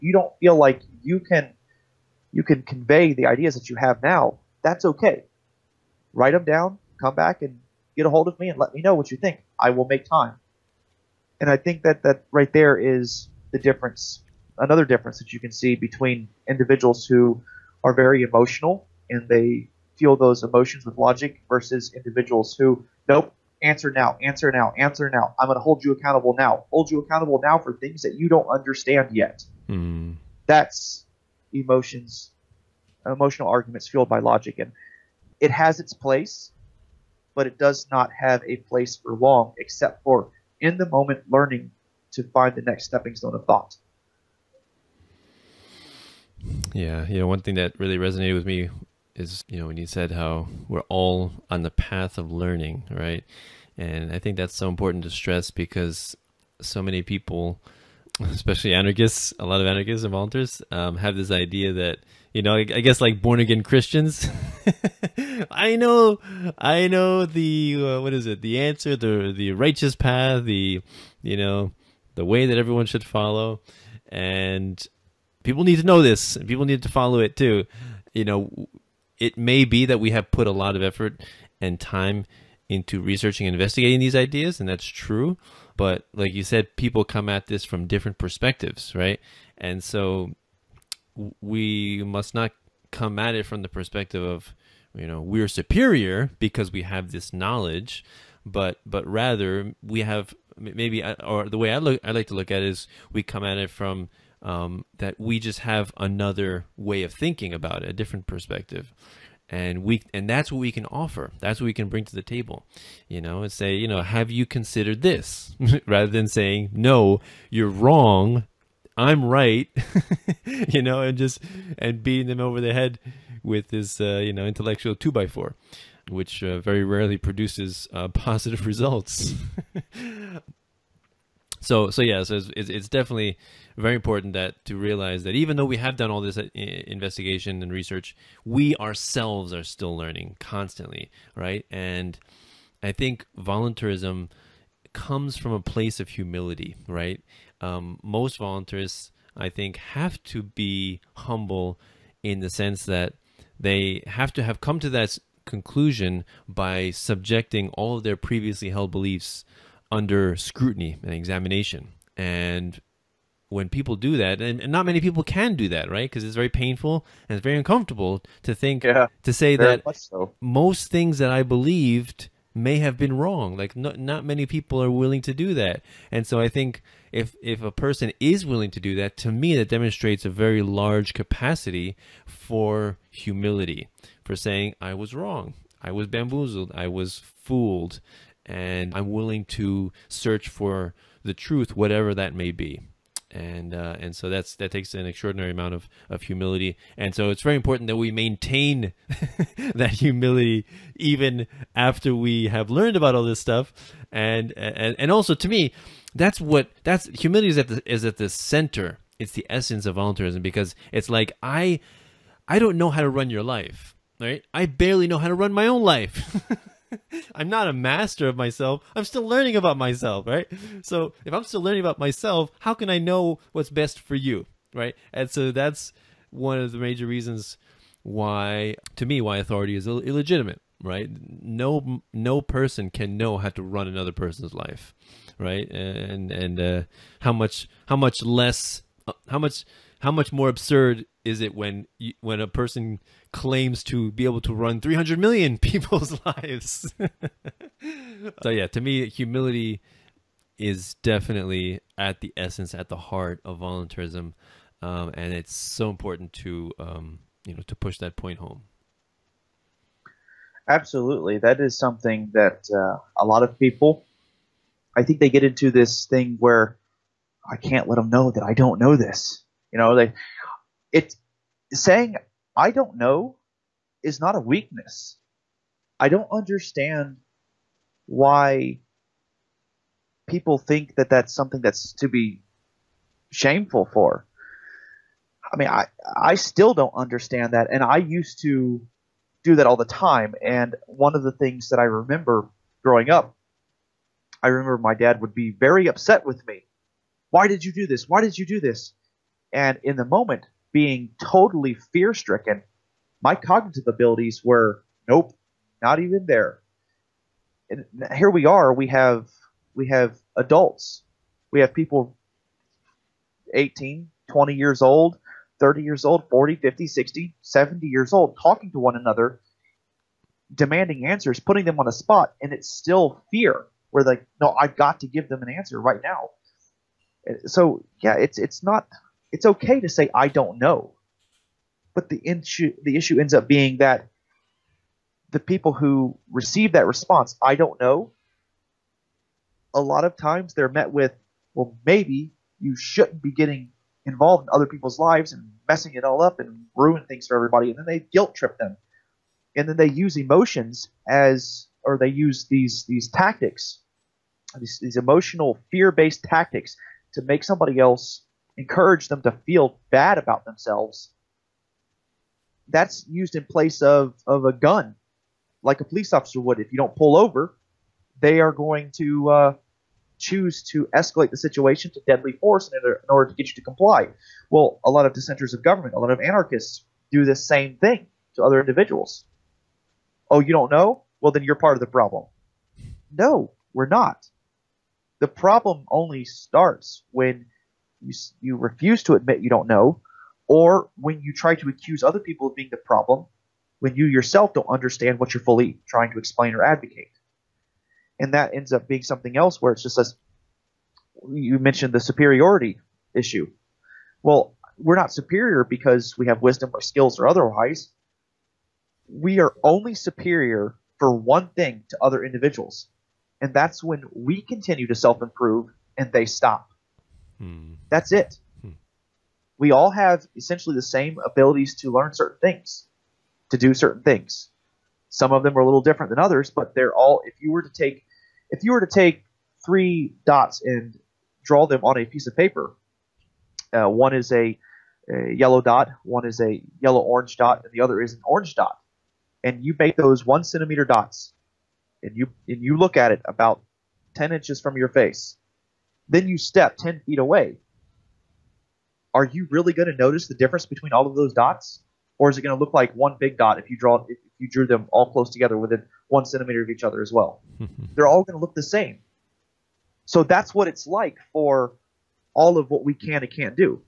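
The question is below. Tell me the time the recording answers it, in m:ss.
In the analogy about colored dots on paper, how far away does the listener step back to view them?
7:26.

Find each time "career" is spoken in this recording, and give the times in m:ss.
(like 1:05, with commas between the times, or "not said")
not said.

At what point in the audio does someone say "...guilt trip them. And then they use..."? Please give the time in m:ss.
5:47.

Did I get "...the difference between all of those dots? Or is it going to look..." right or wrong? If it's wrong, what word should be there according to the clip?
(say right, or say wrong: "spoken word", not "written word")
right.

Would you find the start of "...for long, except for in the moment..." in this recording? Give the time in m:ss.
0:38.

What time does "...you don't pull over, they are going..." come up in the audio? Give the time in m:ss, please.
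6:06.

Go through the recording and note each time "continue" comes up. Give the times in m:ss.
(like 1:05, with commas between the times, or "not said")
6:54.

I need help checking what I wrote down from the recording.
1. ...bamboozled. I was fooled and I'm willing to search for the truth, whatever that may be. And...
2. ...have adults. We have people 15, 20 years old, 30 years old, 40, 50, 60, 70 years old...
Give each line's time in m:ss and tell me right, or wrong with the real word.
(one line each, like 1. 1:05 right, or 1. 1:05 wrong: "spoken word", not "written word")
1. 3:06 right
2. 5:09 wrong: "18", not "15".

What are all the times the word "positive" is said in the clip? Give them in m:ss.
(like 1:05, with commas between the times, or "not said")
2:08.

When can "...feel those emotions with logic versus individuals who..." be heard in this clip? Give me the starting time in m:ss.
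0:19.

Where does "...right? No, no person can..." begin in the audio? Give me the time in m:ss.
3:50.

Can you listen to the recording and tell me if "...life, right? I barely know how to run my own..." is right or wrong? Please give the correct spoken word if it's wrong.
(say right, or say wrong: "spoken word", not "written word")
right.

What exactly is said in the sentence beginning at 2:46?
Because it's very painful and it's very uncomfortable to think, yeah, to say that so.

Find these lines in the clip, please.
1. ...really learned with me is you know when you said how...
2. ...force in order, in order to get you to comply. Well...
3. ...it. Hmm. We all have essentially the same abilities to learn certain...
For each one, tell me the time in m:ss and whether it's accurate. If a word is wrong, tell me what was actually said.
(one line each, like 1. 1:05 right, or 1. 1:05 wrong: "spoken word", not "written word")
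1. 0:47 wrong: "resonated", not "learned"
2. 6:12 right
3. 6:58 right.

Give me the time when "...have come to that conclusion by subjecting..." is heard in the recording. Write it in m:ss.
2:34.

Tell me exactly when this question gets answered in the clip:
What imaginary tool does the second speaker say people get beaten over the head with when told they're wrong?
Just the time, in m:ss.
2:04.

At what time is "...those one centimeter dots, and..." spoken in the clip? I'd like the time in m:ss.
7:19.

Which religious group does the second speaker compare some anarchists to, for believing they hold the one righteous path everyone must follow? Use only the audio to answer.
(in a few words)
Born again Christians.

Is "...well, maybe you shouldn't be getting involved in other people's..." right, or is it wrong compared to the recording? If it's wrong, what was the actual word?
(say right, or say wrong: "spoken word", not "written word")
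right.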